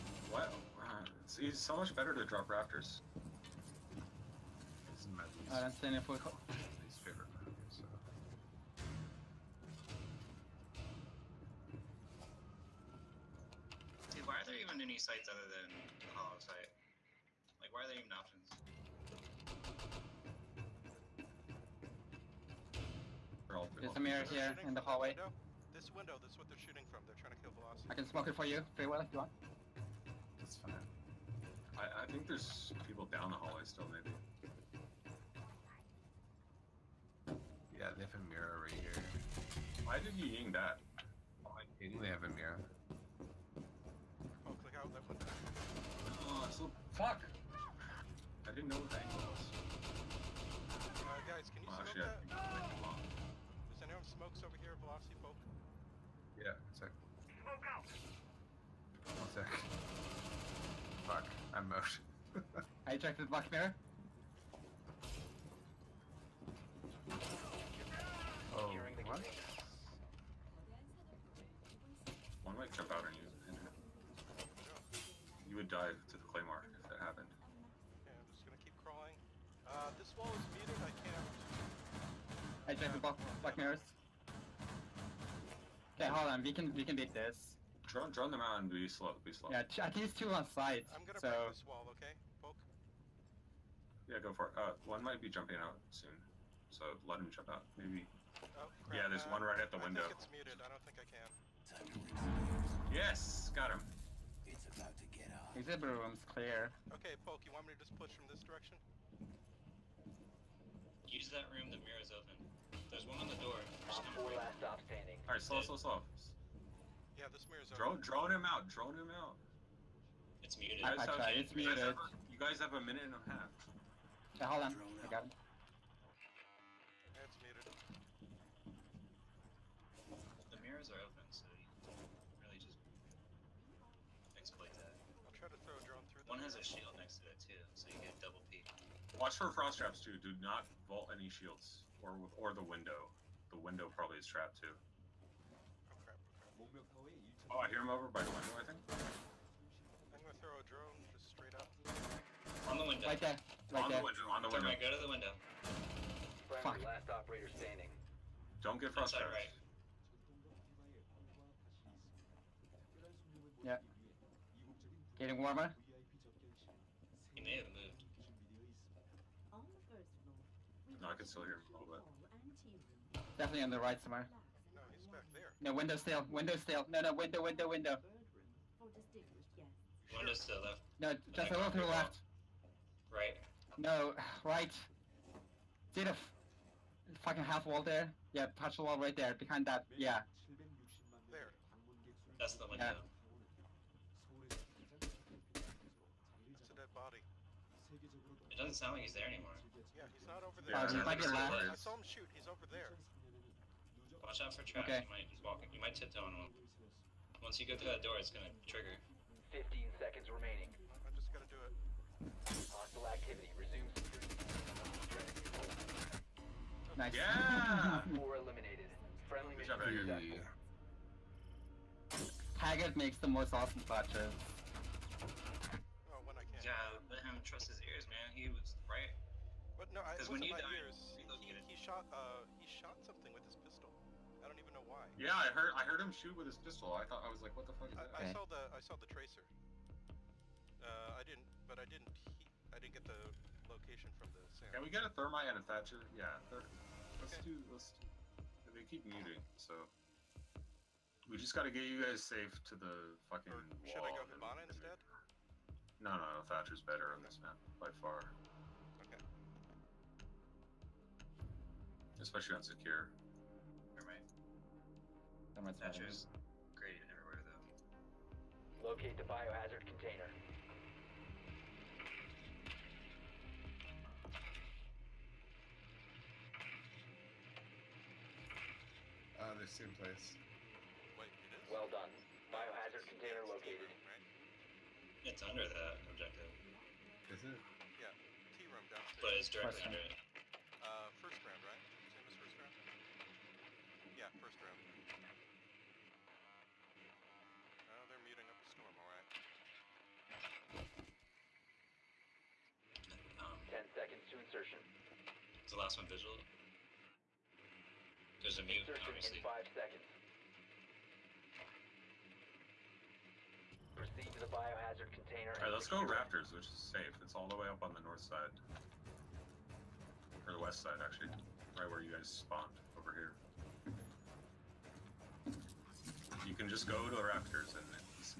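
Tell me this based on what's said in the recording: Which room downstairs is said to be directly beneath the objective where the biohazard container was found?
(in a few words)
T room.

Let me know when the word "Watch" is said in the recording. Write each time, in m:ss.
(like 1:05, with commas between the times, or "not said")
2:19, 3:24.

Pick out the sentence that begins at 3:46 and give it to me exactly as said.
Yeah, let him trust his ears, man.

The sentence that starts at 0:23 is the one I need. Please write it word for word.
There's a mirror here in the hallway.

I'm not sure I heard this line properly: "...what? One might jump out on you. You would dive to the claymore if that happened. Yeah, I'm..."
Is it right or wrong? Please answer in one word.
right.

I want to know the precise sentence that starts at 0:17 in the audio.
Like, why are there even options?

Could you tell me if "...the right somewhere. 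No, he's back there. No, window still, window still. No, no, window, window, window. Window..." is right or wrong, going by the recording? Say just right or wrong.
right.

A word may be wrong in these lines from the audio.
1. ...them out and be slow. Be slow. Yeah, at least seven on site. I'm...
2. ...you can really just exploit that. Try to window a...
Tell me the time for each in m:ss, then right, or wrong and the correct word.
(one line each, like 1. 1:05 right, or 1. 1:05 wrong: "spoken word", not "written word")
1. 1:28 wrong: "two", not "seven"
2. 2:11 wrong: "throw", not "window".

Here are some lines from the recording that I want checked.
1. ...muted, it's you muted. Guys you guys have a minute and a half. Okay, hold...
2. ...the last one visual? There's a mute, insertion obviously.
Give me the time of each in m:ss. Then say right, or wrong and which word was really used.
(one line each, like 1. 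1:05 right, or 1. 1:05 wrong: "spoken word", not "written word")
1. 2:01 wrong: "tried", not "muted"
2. 5:05 right.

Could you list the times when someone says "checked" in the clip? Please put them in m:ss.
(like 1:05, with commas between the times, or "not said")
1:02, 1:22.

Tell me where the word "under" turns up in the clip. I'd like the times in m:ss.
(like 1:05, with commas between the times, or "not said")
4:45, 4:49.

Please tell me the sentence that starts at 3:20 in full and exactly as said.
Uh, he might be I saw him shoot.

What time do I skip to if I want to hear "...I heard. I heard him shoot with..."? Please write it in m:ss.
3:55.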